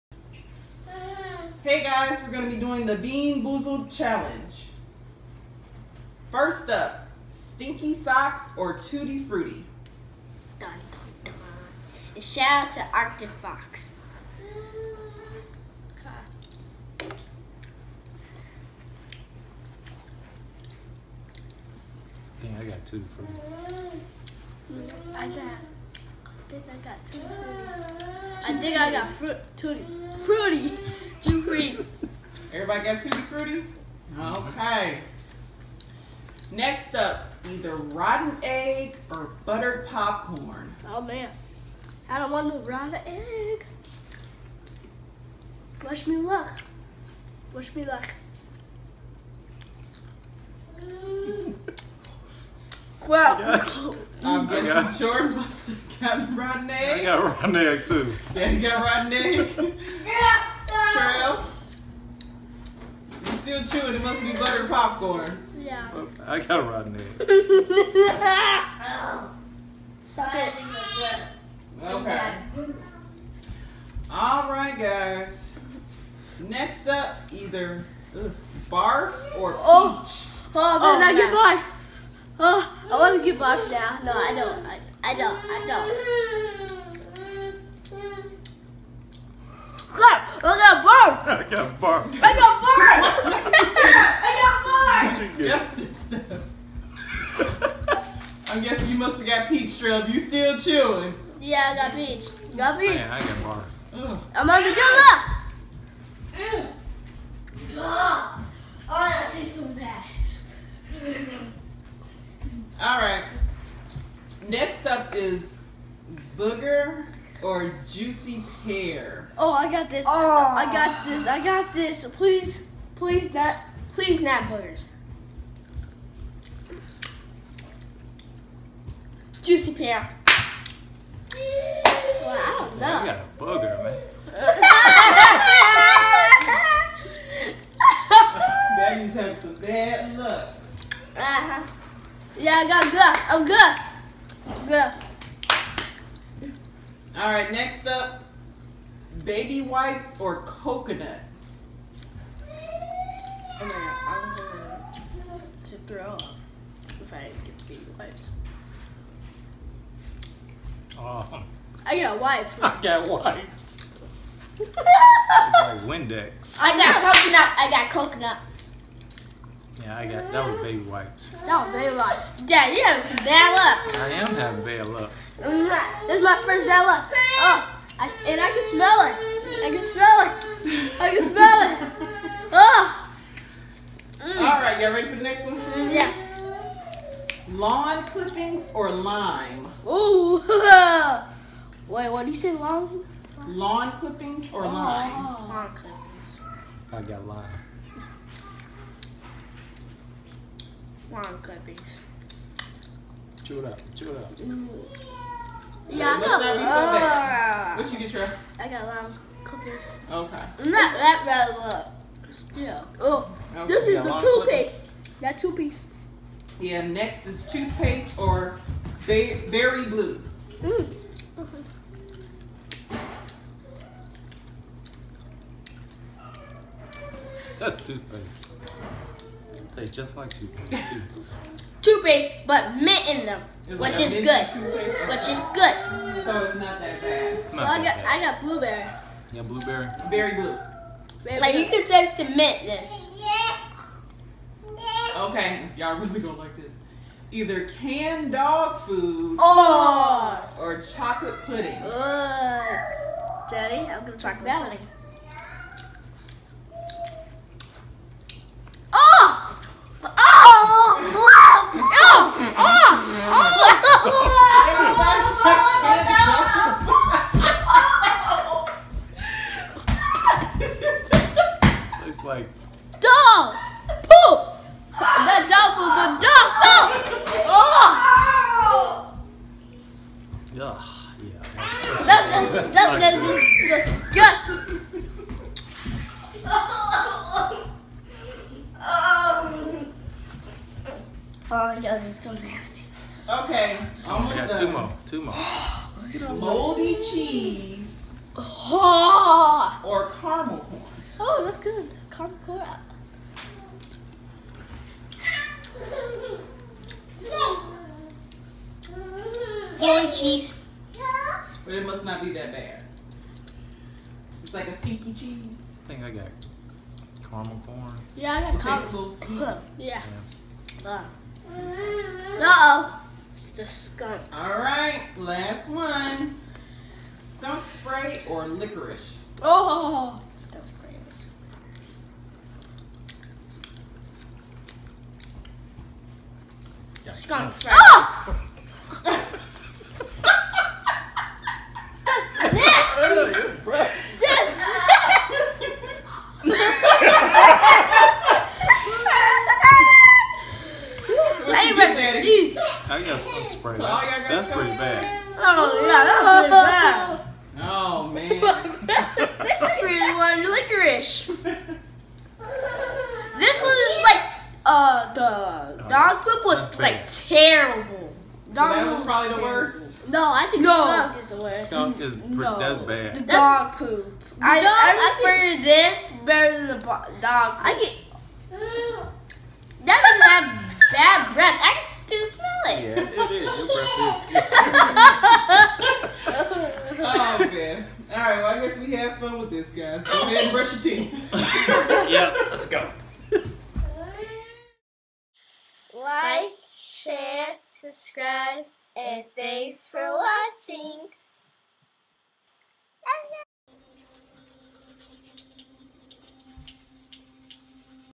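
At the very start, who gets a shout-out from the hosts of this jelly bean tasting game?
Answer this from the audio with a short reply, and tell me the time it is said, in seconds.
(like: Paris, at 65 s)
Arctic Fox, at 12 s.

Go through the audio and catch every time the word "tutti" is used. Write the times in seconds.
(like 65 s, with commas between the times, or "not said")
8 s, 22 s, 33 s.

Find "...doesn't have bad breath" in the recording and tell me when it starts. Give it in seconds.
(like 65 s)
380 s.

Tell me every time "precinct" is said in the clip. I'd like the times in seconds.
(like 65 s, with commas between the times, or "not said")
not said.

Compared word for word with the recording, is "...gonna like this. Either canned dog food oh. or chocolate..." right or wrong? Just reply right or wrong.
right.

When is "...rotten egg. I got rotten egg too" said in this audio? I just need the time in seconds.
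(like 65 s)
56 s.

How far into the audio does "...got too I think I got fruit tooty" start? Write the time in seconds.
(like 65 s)
26 s.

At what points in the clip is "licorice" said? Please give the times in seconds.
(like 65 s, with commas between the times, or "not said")
328 s.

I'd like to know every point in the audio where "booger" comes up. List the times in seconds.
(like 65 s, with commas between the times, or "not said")
116 s, 124 s, 133 s.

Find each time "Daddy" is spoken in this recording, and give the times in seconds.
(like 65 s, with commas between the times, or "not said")
58 s, 138 s, 253 s.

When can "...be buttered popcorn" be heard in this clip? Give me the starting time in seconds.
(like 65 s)
64 s.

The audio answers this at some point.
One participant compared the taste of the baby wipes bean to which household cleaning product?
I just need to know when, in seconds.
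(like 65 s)
165 s.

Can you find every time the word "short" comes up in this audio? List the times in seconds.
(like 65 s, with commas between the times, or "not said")
54 s.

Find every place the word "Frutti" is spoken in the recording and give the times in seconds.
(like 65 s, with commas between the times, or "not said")
9 s, 23 s.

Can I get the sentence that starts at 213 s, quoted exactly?
Oh, okay, this is the toothpaste.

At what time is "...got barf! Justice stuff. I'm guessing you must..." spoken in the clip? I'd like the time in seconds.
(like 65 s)
95 s.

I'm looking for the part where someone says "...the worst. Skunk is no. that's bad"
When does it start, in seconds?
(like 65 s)
371 s.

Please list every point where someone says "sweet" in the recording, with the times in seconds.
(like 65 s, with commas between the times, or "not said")
319 s.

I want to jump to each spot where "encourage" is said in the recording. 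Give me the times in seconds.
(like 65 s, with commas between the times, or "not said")
not said.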